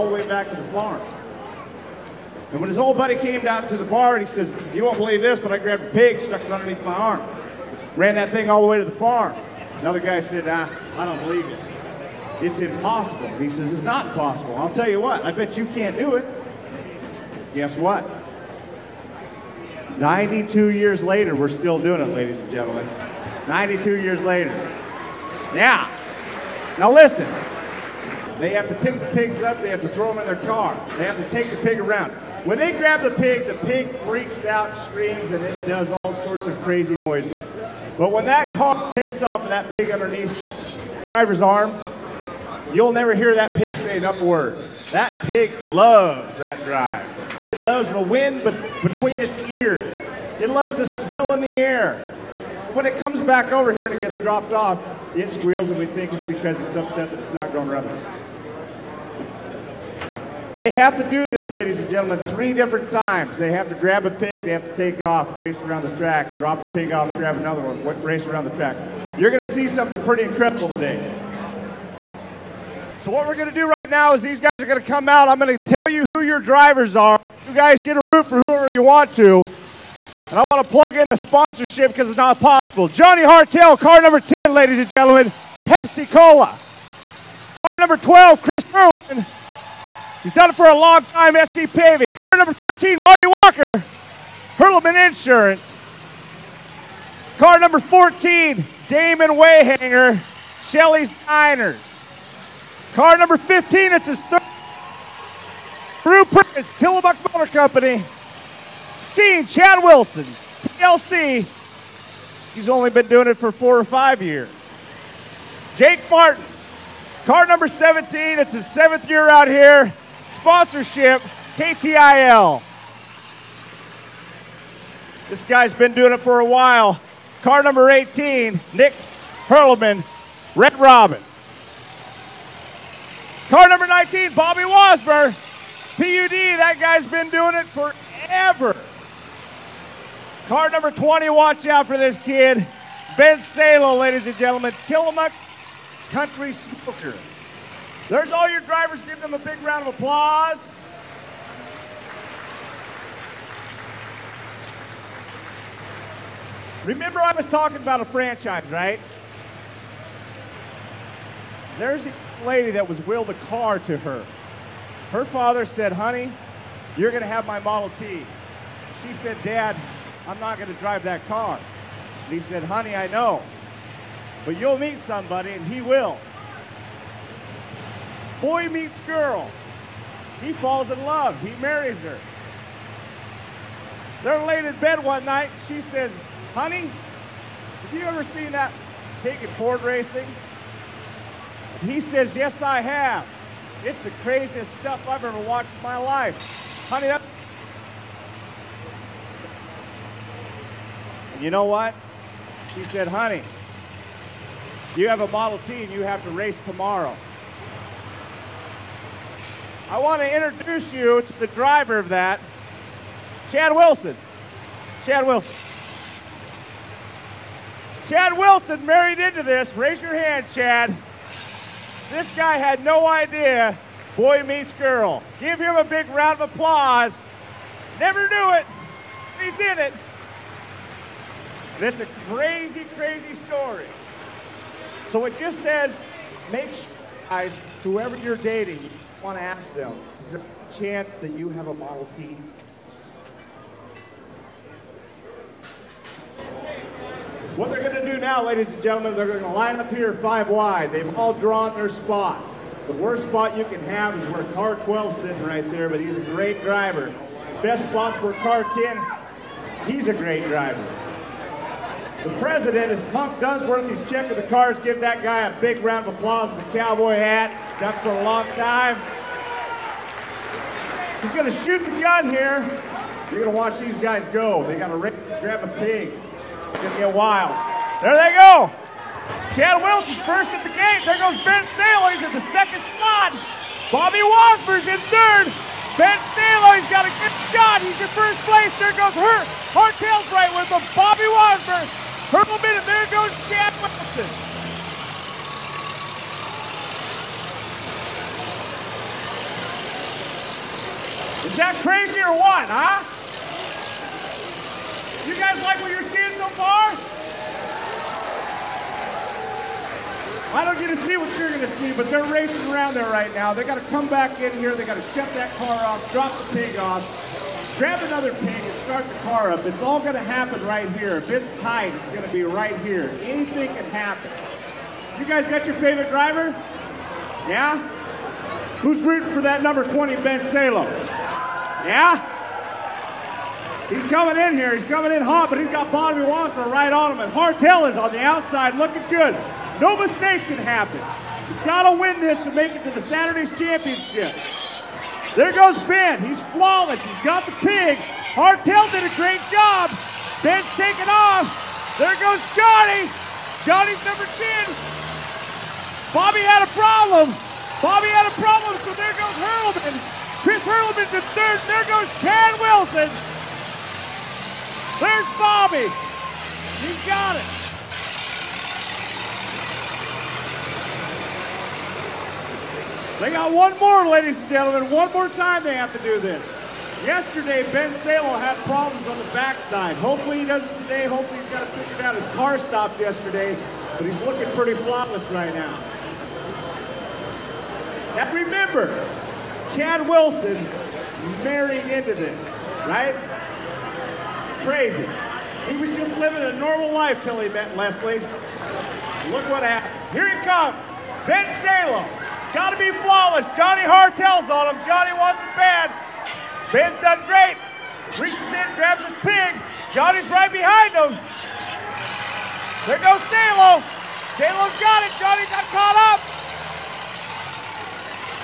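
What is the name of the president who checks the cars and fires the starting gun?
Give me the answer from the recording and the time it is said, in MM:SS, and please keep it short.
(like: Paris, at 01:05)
Punk Dunsworth, at 04:23.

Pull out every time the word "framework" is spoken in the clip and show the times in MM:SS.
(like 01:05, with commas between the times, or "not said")
not said.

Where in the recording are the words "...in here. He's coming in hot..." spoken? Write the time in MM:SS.
05:34.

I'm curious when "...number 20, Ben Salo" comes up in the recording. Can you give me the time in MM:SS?
05:29.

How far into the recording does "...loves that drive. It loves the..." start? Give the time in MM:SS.
00:45.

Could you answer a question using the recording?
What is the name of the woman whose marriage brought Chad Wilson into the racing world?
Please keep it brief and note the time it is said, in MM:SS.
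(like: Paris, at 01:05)
Leslie, at 06:37.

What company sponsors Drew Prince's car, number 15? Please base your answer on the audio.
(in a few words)
Tillamook Motor Company.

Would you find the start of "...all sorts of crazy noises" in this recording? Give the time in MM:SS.
00:35.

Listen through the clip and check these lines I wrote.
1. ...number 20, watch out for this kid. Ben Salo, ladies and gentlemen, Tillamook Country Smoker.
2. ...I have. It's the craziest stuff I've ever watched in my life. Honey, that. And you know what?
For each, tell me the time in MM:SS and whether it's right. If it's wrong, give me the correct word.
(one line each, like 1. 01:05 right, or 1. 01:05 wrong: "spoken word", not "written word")
1. 02:20 right
2. 03:12 right.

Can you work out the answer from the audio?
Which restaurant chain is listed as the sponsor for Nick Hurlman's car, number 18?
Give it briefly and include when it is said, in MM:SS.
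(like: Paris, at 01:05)
Red Robin, at 02:10.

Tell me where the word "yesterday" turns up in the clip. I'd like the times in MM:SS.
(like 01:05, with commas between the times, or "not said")
06:17, 06:22.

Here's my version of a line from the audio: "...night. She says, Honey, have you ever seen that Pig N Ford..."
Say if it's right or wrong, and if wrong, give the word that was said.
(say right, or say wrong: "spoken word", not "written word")
right.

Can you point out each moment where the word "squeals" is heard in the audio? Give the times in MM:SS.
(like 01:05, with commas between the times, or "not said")
00:55.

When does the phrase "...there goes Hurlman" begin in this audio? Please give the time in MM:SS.
05:58.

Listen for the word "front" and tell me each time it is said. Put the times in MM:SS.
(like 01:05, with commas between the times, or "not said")
not said.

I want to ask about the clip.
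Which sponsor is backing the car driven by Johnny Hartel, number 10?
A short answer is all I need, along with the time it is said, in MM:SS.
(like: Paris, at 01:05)
Pepsi Cola, at 01:25.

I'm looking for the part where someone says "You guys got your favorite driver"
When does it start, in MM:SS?
05:25.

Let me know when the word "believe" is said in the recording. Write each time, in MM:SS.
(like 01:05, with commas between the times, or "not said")
00:04, 00:11.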